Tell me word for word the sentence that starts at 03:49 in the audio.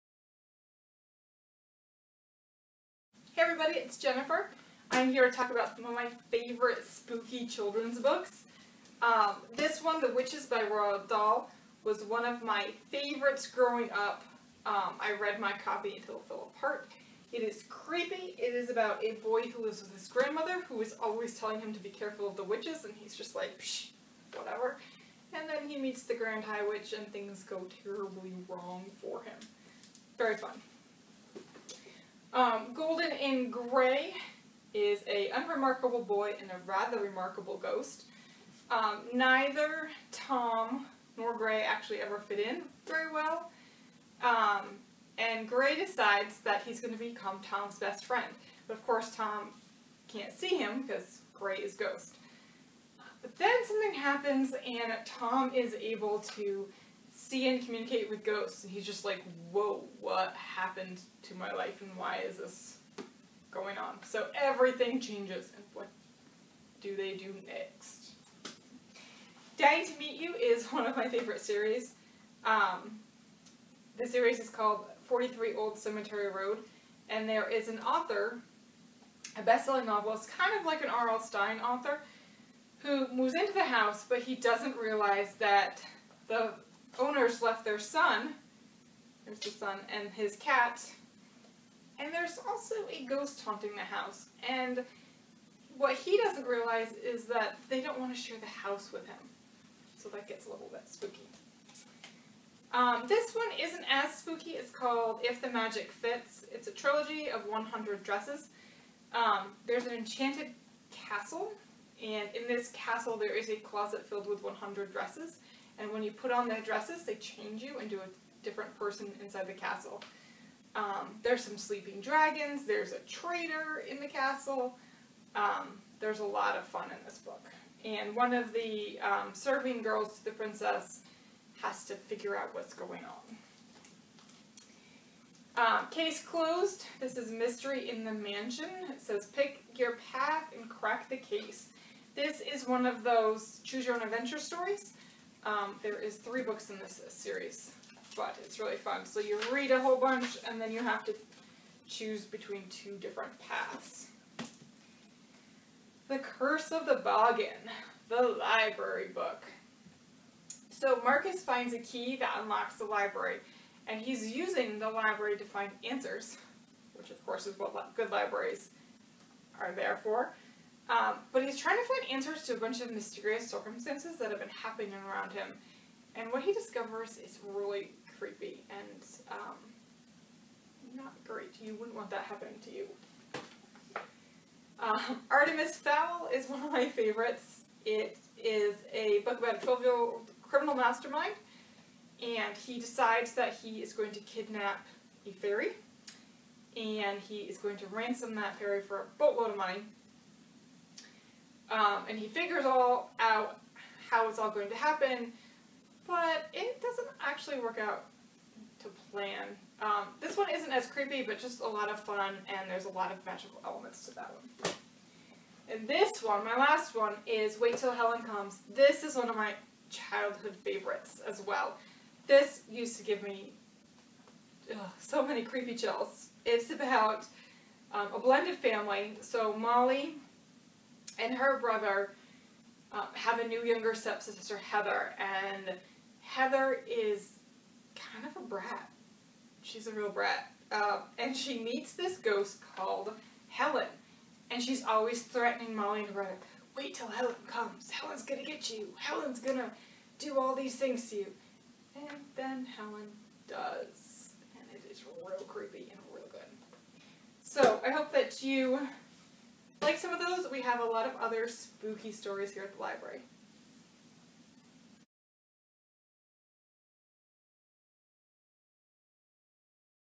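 So Molly, and her brother um, have a new younger stepsister, Heather, and Heather is kind of a brat.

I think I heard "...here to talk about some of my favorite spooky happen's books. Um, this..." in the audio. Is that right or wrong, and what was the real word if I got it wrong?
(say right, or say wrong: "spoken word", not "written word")
wrong: "children", not "happen".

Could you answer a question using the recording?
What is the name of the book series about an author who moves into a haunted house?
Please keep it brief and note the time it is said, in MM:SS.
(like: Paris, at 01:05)
43 Old Cemetery Road, at 01:15.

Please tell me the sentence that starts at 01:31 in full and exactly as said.
And there's also a ghost haunting the house.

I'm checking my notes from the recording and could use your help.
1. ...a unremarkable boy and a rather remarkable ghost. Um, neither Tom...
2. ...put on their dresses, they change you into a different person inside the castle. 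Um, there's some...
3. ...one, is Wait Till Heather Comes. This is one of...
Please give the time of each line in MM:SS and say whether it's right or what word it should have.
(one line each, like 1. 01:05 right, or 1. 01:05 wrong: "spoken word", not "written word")
1. 00:35 right
2. 01:56 right
3. 03:36 wrong: "Helen", not "Heather".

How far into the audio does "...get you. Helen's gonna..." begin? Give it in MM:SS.
04:08.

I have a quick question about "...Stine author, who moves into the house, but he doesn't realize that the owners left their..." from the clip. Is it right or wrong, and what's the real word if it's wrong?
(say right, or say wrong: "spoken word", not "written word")
right.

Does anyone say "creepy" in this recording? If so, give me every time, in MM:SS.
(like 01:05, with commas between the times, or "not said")
00:17, 02:58, 03:30, 03:45, 04:15.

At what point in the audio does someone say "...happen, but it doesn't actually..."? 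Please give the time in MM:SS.
03:24.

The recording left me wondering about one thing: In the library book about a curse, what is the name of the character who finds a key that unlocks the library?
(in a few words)
Marcus.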